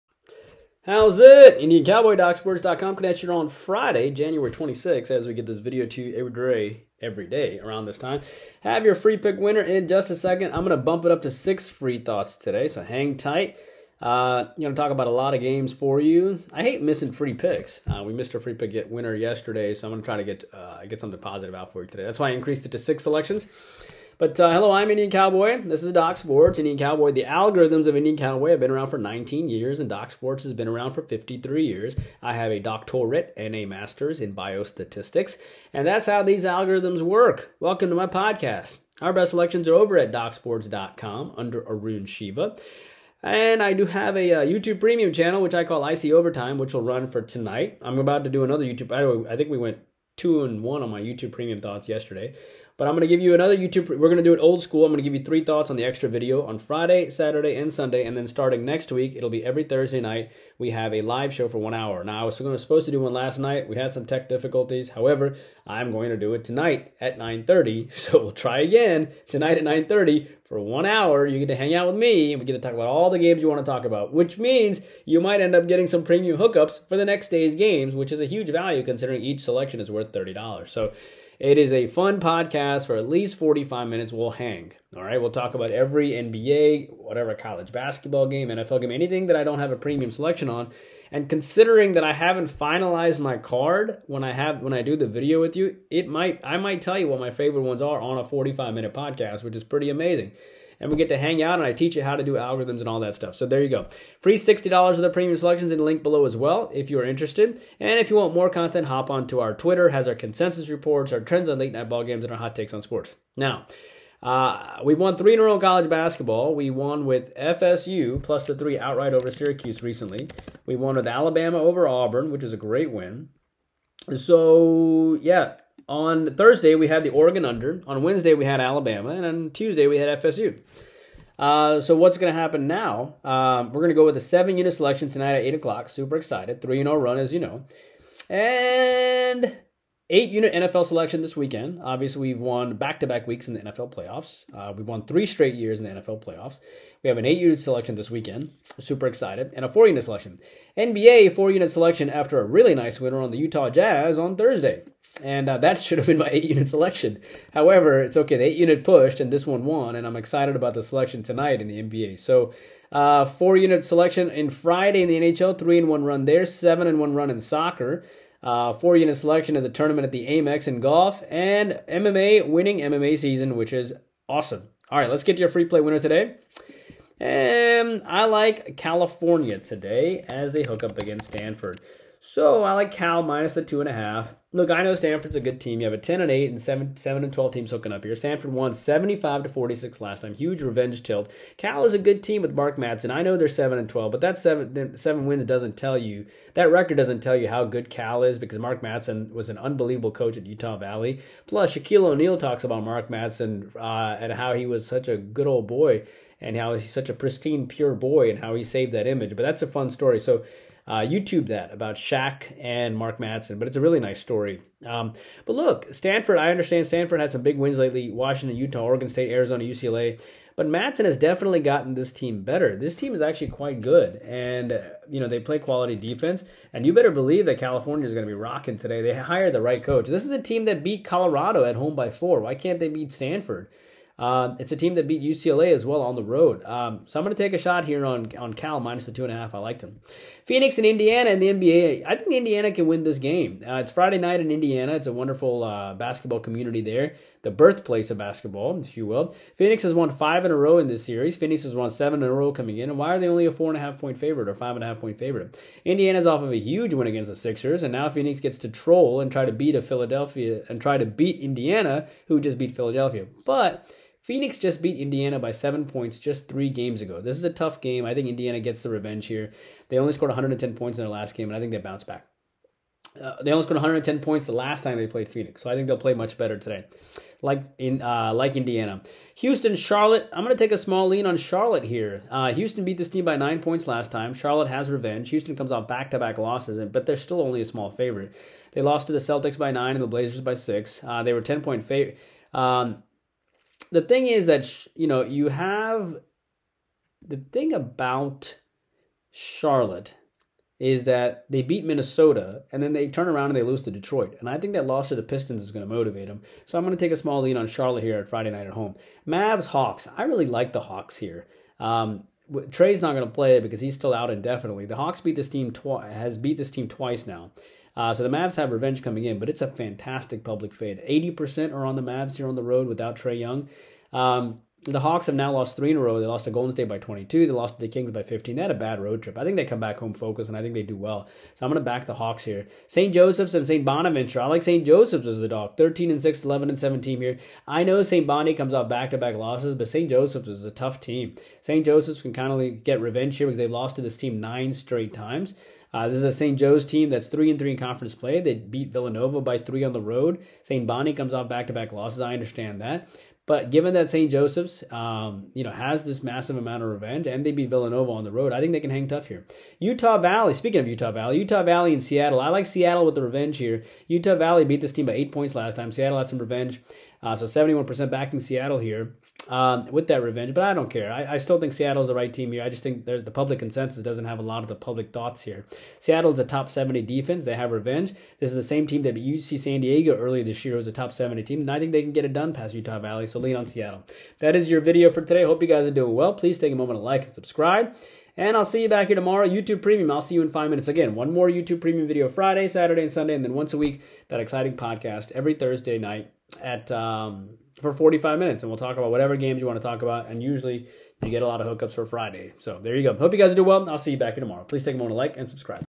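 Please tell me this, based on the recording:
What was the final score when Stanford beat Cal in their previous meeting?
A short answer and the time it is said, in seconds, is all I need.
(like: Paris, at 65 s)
75 to 46, at 188 s.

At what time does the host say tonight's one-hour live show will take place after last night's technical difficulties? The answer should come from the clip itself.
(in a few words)
9:30.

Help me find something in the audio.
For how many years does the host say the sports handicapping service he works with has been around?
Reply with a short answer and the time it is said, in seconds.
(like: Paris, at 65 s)
53 years, at 31 s.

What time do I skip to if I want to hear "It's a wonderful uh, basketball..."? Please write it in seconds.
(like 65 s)
244 s.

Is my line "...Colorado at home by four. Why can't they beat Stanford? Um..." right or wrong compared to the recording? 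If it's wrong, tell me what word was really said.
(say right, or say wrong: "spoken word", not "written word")
right.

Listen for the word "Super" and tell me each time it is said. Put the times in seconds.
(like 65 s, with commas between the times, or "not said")
135 s, 148 s.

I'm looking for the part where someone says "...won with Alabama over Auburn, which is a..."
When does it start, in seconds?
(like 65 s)
120 s.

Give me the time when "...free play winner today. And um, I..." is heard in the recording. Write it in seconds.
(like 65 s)
175 s.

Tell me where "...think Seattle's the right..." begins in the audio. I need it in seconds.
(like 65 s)
371 s.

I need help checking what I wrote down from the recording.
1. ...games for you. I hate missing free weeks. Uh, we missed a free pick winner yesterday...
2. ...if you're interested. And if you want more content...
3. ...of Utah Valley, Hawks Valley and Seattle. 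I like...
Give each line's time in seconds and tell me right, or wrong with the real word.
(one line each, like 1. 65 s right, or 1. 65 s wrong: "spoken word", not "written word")
1. 15 s wrong: "picks", not "weeks"
2. 106 s right
3. 360 s wrong: "Utah", not "Hawks".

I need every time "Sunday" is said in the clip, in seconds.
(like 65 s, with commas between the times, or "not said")
57 s, 393 s.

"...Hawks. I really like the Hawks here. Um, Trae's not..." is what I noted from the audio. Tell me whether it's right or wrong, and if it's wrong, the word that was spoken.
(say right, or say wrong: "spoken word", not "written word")
right.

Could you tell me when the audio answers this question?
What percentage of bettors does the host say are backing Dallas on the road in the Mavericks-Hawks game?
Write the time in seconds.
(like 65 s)
320 s.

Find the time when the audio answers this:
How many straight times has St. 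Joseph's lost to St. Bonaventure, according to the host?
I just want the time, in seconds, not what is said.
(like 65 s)
344 s.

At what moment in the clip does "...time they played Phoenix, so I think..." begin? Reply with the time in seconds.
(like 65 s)
274 s.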